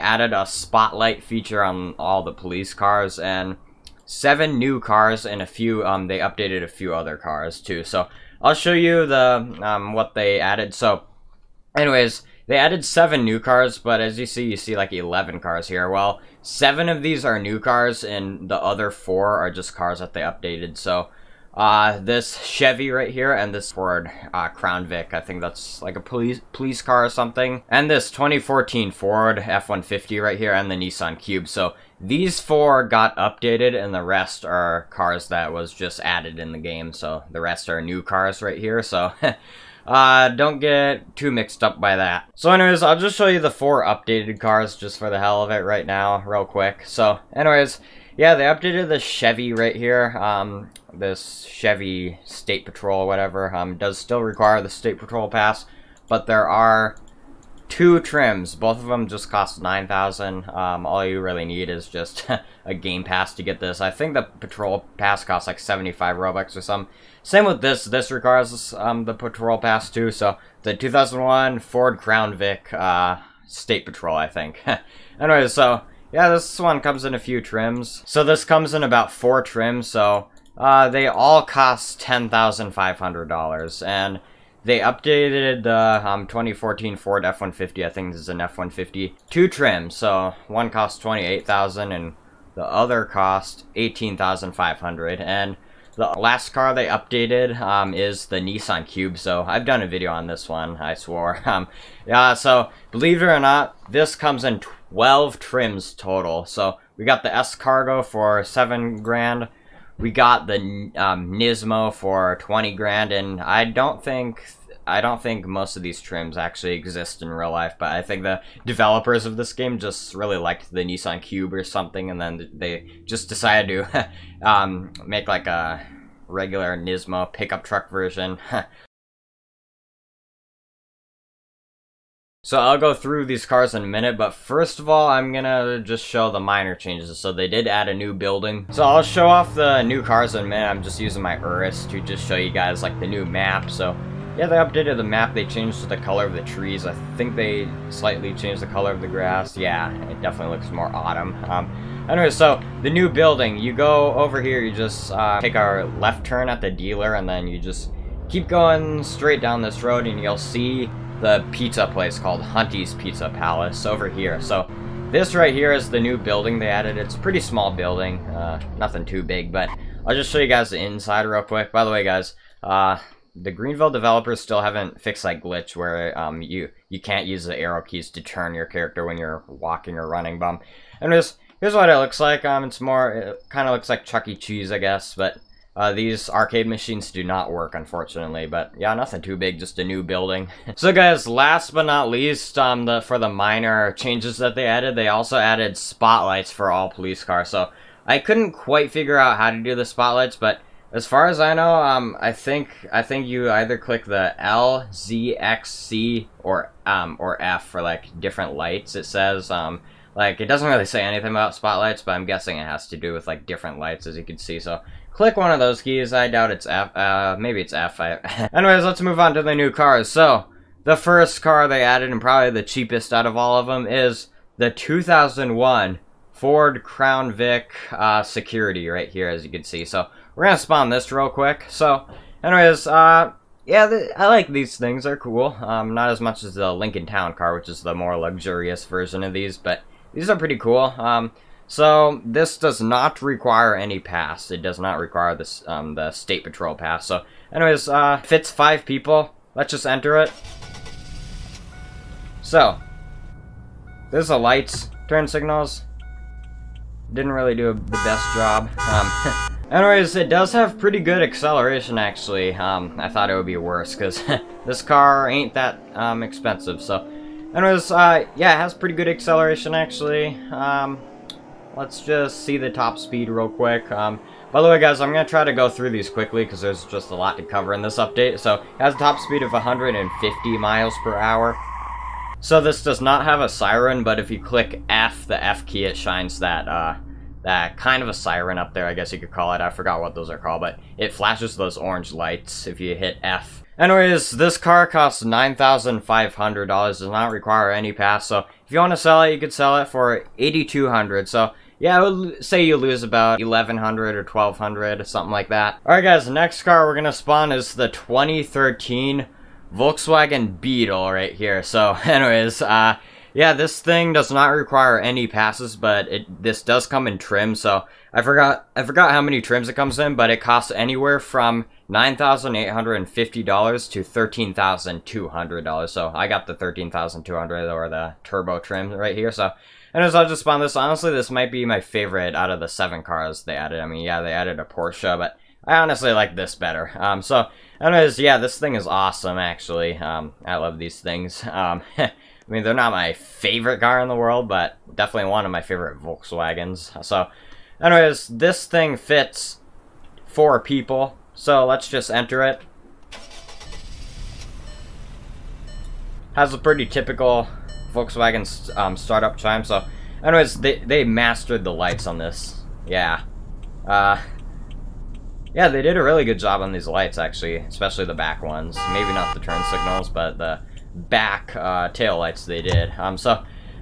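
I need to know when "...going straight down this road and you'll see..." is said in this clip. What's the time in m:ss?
2:38.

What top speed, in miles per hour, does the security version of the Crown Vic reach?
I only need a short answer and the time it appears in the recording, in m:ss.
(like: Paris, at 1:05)
150, at 4:39.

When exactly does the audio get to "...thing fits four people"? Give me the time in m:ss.
5:48.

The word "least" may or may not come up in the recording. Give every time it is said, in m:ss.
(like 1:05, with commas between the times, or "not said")
3:12.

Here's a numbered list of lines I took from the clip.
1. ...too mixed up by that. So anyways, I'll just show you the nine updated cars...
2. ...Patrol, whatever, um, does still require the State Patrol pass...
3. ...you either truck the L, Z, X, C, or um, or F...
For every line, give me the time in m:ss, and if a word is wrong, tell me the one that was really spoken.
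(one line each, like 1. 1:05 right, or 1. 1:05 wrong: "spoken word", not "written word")
1. 0:41 wrong: "four", not "nine"
2. 0:52 right
3. 3:23 wrong: "click", not "truck".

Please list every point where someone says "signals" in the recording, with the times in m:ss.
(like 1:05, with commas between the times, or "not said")
4:15, 6:09.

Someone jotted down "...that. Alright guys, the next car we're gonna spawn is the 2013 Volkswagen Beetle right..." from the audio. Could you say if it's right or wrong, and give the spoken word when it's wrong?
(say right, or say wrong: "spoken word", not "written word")
right.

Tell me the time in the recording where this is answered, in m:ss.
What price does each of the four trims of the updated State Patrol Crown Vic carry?
1:22.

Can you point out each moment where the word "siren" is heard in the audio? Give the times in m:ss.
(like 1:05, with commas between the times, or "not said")
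4:43, 4:48.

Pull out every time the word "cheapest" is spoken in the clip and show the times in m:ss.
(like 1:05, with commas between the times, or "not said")
3:42.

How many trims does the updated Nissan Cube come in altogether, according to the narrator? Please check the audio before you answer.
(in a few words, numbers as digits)
12.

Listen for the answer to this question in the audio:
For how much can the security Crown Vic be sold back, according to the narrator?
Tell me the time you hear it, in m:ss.
5:00.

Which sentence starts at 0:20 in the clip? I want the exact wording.
So uh, this Chevy right here and this Ford uh, Crown Vic.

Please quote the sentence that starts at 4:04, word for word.
It does not require this um, the state patrol pass.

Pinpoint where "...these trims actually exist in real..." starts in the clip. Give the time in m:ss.
1:55.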